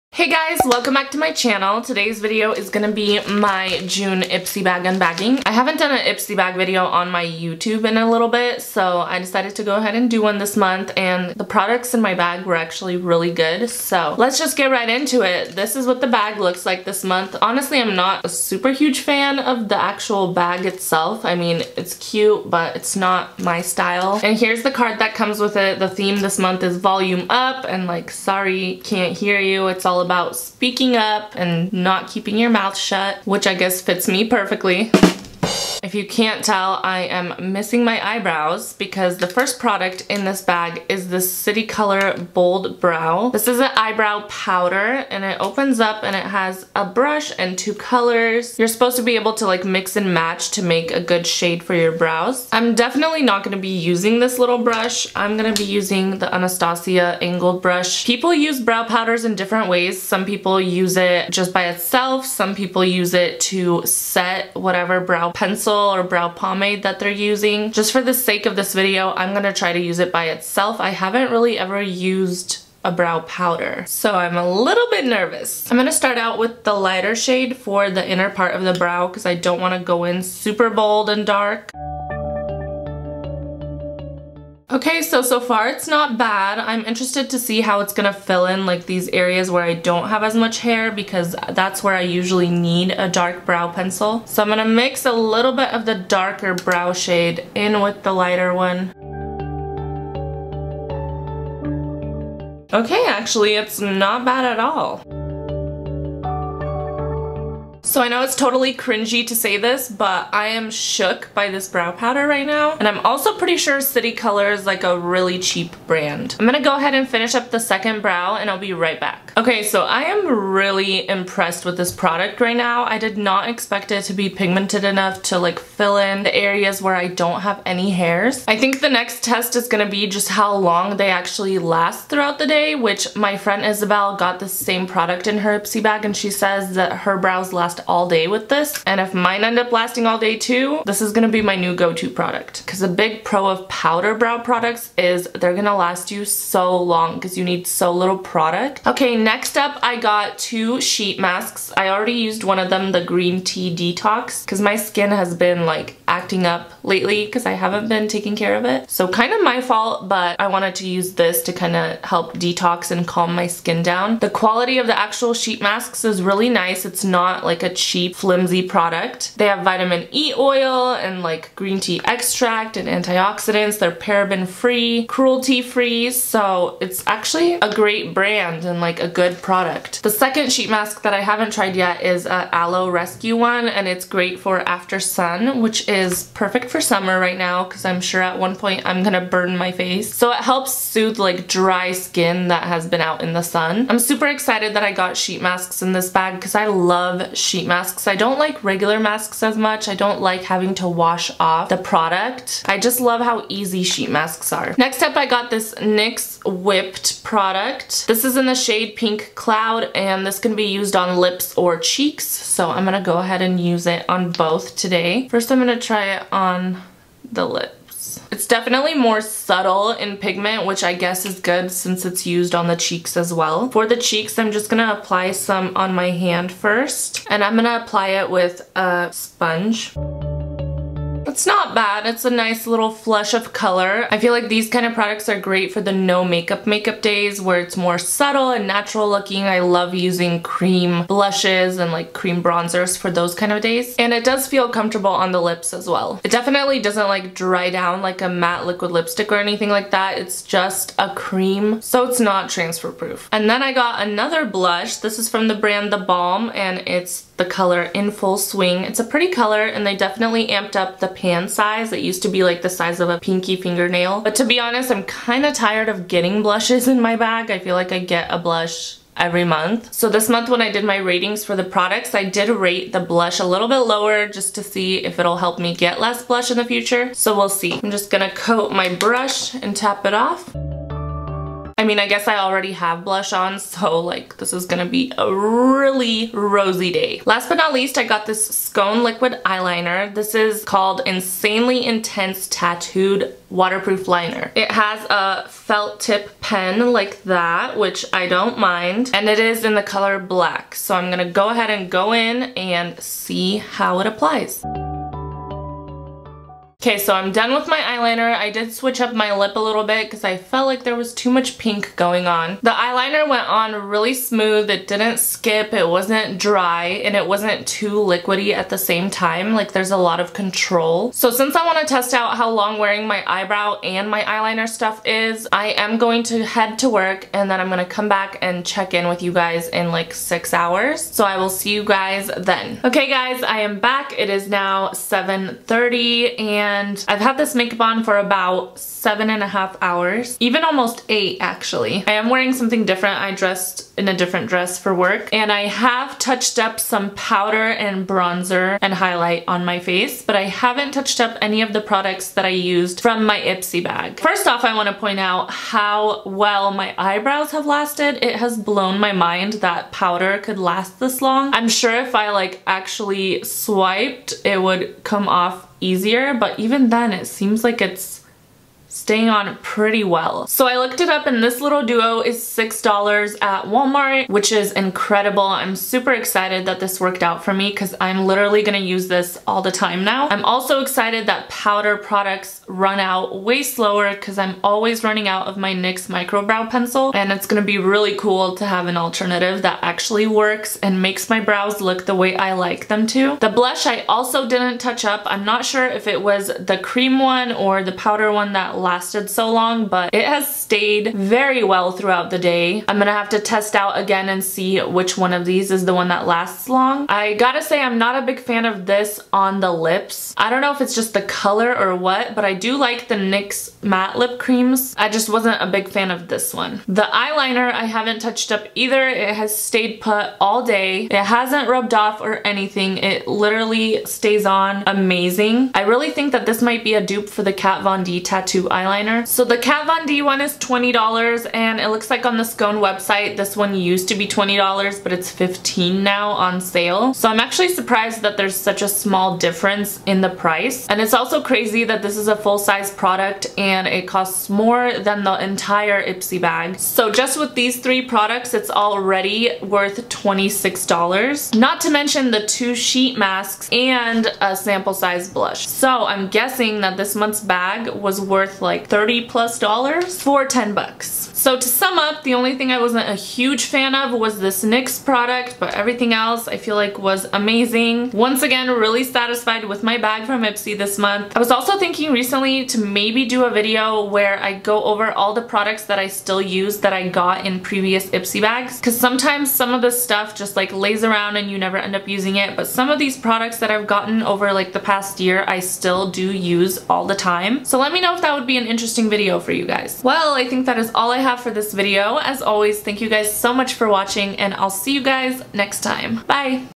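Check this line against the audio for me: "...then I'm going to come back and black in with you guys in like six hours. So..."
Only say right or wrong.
wrong.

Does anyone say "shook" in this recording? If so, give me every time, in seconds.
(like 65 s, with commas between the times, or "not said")
110 s.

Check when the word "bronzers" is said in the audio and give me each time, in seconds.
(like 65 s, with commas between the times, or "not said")
242 s, 348 s.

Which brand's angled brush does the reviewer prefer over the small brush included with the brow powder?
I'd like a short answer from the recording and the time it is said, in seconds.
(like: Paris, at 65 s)
Anastasia, at 56 s.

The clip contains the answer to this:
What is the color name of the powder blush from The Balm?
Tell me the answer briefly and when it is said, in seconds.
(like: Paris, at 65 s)
In Full Swing, at 257 s.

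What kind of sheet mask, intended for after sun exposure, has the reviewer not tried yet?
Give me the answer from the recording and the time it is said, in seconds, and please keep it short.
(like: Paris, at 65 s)
Aloe rescue, at 182 s.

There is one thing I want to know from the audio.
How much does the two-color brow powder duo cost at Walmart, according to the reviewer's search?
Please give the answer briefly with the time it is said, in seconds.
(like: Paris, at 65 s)
$6, at 372 s.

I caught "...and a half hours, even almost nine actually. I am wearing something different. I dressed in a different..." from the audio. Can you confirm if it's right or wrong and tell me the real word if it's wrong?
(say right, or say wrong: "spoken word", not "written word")
wrong: "eight", not "nine".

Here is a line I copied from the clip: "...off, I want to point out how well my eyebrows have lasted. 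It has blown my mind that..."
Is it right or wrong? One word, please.
right.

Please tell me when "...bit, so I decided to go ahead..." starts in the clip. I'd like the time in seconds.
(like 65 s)
8 s.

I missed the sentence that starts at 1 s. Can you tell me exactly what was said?
Today's video is gonna be my June Ipsy bag unbagging.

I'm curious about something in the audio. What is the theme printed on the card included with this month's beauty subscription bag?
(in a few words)
Volume up.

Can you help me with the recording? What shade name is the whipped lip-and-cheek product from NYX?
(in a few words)
Pink Cloud.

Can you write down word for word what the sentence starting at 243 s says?
And it does feel comfortable on the lips as well.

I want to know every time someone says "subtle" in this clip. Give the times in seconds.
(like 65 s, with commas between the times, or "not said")
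219 s, 237 s.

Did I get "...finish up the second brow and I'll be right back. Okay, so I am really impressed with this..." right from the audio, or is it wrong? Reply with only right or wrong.
right.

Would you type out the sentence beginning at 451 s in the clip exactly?
Not to mention the two sheet masks and a sample size blush.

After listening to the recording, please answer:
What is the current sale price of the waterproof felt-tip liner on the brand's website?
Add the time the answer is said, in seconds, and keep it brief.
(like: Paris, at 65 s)
$15, at 435 s.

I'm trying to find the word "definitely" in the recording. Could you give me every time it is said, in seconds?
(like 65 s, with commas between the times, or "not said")
52 s, 218 s, 246 s, 259 s.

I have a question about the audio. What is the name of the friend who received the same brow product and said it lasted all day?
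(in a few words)
Isabel.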